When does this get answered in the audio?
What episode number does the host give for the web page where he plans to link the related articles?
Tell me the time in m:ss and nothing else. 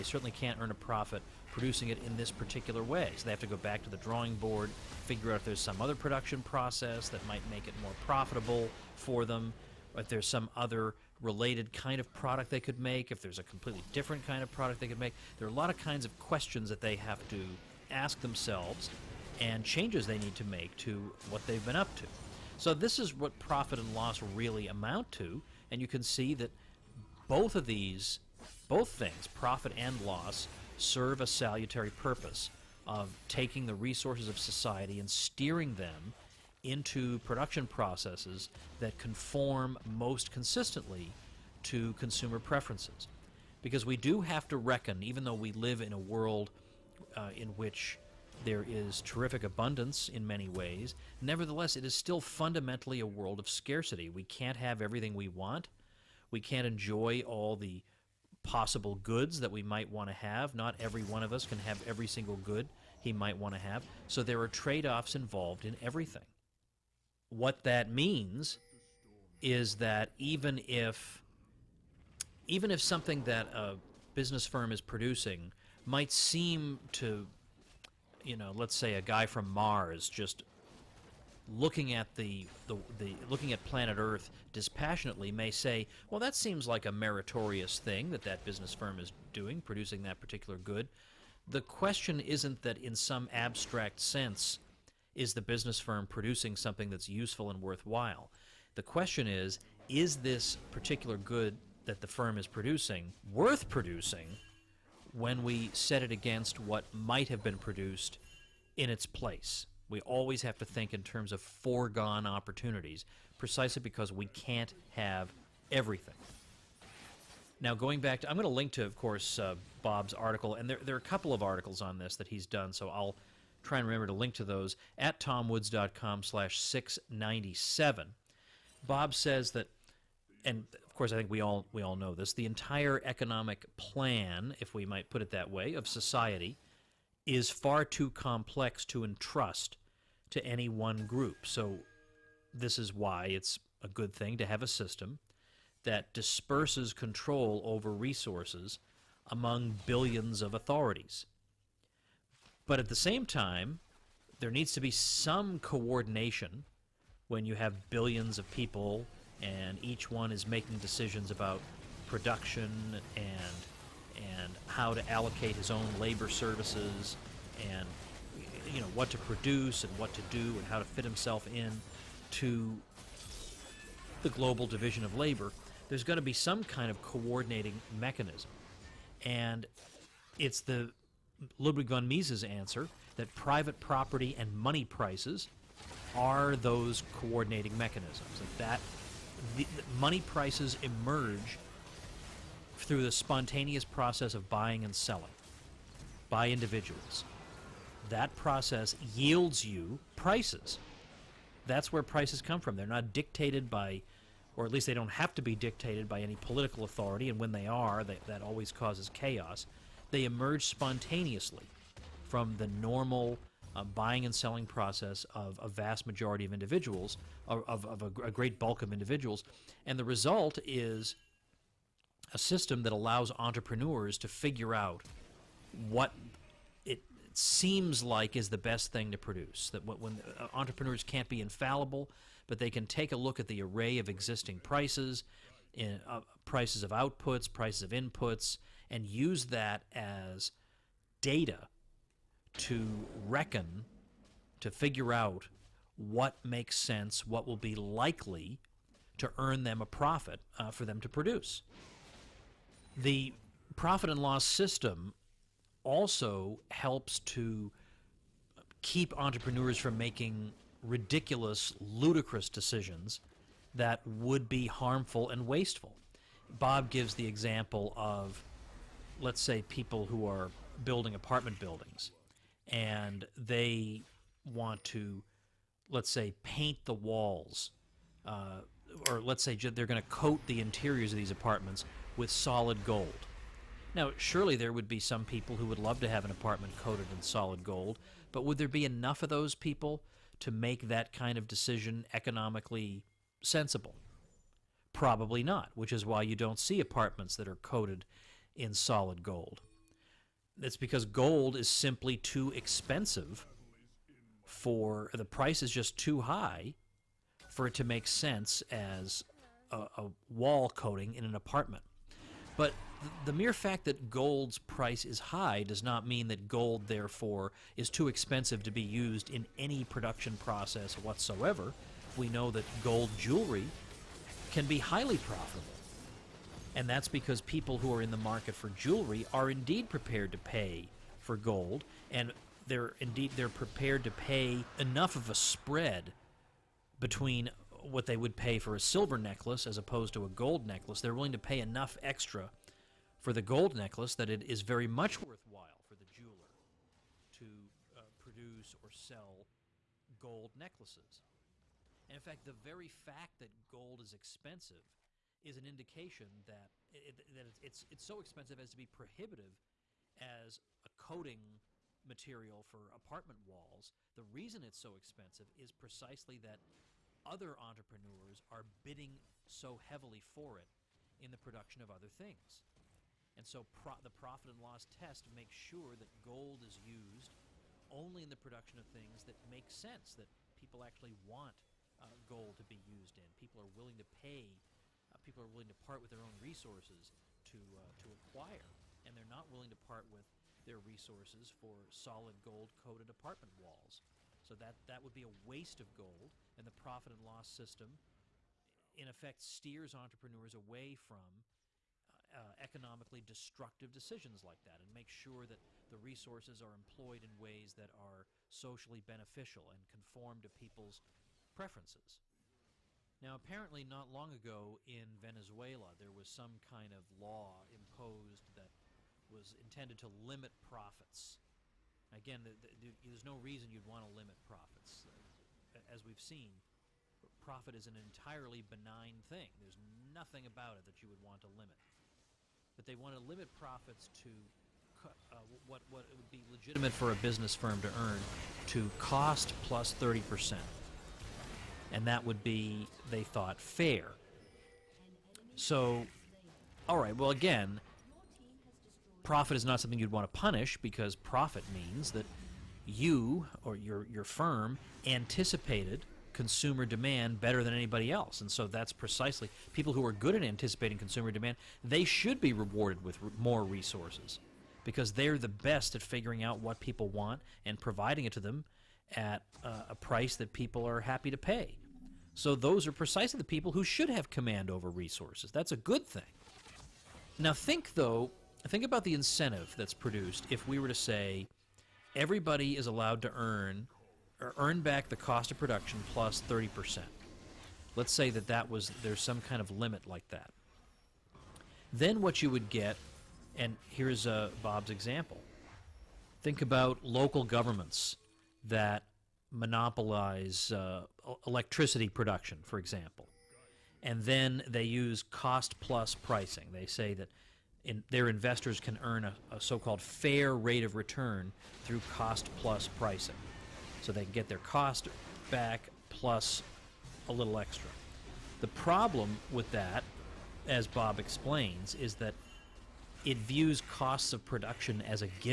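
2:06.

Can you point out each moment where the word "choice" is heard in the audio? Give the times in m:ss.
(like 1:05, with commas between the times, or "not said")
not said.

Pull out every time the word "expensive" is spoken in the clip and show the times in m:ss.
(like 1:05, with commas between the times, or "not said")
5:02, 5:18, 5:54, 5:58, 6:04.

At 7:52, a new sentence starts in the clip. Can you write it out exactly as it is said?
So those are precisely the people who should have command over resources.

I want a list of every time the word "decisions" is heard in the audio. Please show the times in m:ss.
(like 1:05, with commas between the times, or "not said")
2:40, 4:22, 4:51, 6:43.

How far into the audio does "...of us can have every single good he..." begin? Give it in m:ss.
1:01.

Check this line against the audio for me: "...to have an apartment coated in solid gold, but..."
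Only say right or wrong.
right.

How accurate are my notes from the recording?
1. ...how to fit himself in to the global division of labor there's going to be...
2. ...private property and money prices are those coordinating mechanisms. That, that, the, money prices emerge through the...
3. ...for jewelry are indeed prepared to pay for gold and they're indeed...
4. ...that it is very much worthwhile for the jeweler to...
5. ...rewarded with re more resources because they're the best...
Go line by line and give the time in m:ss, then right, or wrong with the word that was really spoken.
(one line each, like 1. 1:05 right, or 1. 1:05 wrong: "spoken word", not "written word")
1. 2:50 right
2. 3:03 right
3. 5:28 right
4. 5:44 right
5. 7:42 right.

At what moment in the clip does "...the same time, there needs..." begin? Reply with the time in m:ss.
2:32.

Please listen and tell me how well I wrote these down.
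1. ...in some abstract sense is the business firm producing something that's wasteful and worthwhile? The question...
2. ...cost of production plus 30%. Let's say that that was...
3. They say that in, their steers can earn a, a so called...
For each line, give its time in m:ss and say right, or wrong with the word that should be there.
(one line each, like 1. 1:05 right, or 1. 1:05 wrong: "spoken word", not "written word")
1. 1:32 wrong: "useful", not "wasteful"
2. 8:05 right
3. 8:26 wrong: "investors", not "steers".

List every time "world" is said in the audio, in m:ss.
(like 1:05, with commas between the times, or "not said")
0:45, 0:53.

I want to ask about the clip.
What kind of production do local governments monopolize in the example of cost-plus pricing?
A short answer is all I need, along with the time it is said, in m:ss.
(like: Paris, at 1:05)
electricity, at 8:21.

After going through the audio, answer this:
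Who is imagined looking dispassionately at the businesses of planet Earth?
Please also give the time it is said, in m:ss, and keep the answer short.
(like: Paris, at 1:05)
a guy from Mars, at 1:18.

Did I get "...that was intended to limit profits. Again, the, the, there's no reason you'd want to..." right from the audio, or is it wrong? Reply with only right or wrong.
right.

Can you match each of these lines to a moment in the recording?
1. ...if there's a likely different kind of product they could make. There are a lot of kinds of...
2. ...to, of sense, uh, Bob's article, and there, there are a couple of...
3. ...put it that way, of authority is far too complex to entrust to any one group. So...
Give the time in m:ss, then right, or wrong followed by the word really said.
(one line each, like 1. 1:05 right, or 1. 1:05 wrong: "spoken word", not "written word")
1. 0:13 wrong: "completely", not "likely"
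2. 1:58 wrong: "course", not "sense"
3. 2:15 wrong: "society", not "authority".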